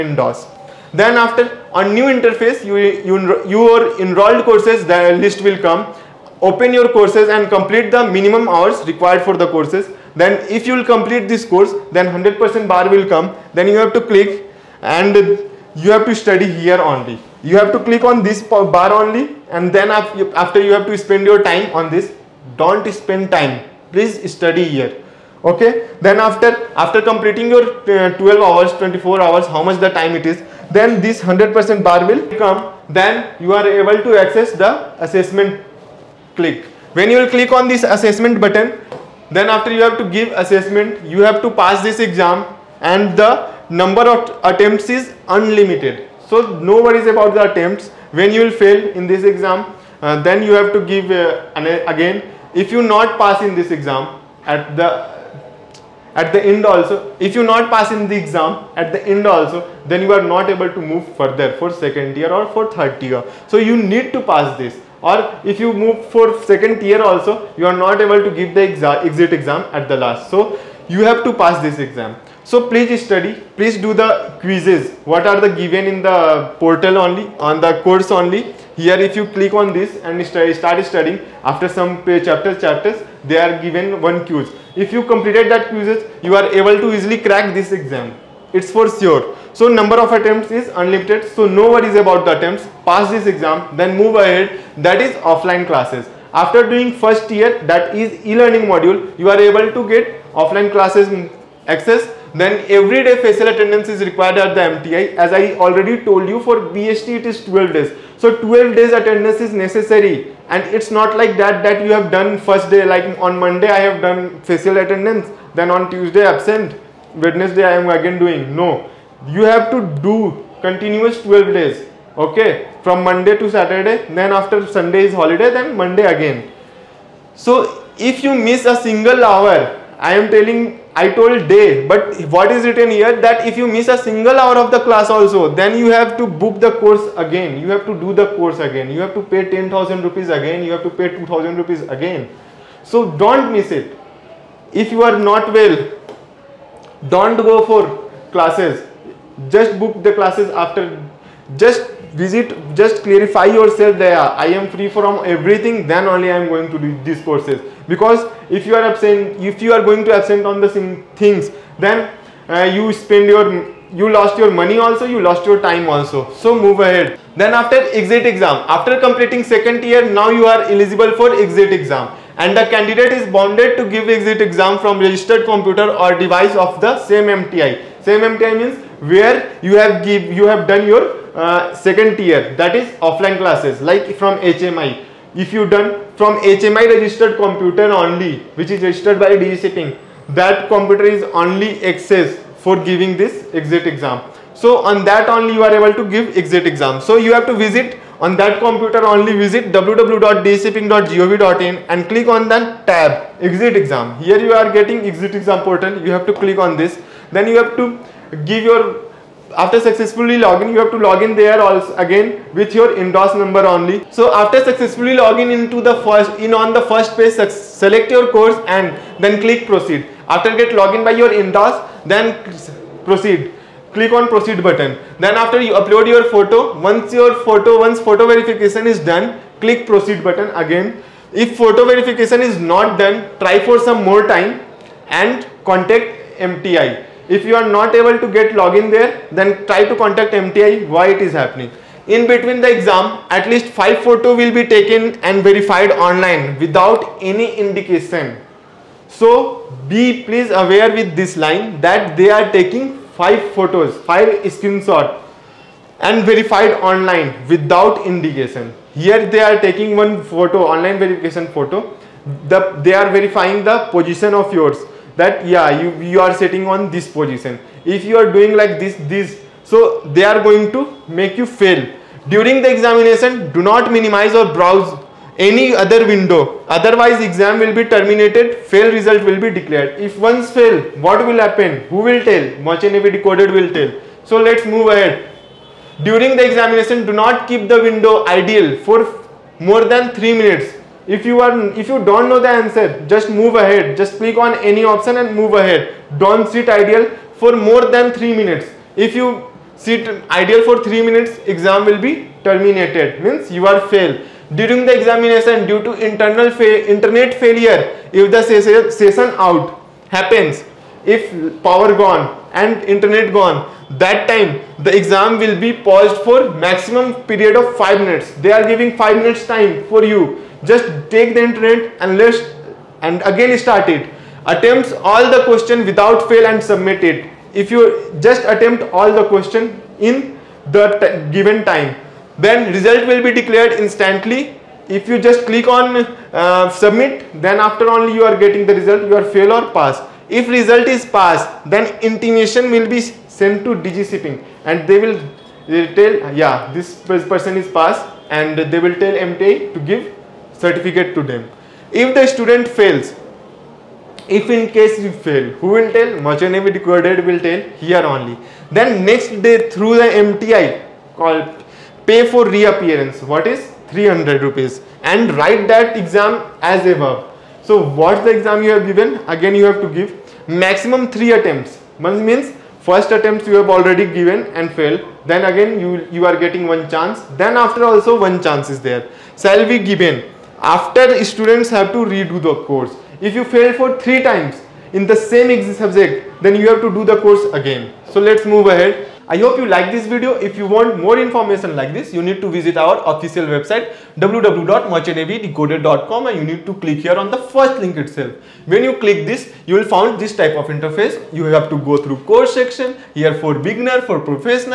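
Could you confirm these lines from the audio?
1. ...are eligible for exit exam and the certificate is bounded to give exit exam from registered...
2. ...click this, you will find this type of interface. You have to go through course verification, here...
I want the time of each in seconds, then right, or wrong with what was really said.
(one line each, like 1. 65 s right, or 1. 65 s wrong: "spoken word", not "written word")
1. 170 s wrong: "candidate", not "certificate"
2. 398 s wrong: "section", not "verification".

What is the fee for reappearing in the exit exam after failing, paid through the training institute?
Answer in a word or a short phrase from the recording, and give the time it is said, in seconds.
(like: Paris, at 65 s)
300 rupees, at 363 s.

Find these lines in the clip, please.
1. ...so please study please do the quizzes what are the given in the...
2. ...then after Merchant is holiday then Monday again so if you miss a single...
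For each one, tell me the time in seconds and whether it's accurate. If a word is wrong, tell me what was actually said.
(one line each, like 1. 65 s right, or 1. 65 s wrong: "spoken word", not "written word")
1. 72 s right
2. 124 s wrong: "Sunday", not "Merchant".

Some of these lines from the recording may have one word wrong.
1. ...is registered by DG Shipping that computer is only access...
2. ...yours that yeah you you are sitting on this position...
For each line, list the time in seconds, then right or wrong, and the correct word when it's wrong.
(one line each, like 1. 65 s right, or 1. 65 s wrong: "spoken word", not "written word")
1. 188 s right
2. 264 s right.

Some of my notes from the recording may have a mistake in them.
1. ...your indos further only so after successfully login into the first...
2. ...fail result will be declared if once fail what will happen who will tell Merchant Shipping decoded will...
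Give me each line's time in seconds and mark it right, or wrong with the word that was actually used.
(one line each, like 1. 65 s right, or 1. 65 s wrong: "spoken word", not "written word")
1. 212 s wrong: "number", not "further"
2. 278 s wrong: "Navy", not "Shipping".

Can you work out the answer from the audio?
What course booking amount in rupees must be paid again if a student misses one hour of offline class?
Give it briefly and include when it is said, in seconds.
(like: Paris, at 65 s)
10,000 rupees, at 139 s.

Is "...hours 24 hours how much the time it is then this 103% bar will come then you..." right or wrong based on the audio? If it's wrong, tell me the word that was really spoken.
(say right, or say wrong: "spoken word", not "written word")
wrong: "100", not "103".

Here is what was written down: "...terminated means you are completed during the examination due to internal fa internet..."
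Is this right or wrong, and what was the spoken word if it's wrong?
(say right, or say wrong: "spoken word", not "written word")
wrong: "failed", not "completed".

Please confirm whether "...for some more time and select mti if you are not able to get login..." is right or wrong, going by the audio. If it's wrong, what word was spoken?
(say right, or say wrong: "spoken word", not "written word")
wrong: "contact", not "select".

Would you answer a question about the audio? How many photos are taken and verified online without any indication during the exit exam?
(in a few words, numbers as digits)
5.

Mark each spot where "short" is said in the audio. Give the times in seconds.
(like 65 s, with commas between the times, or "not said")
not said.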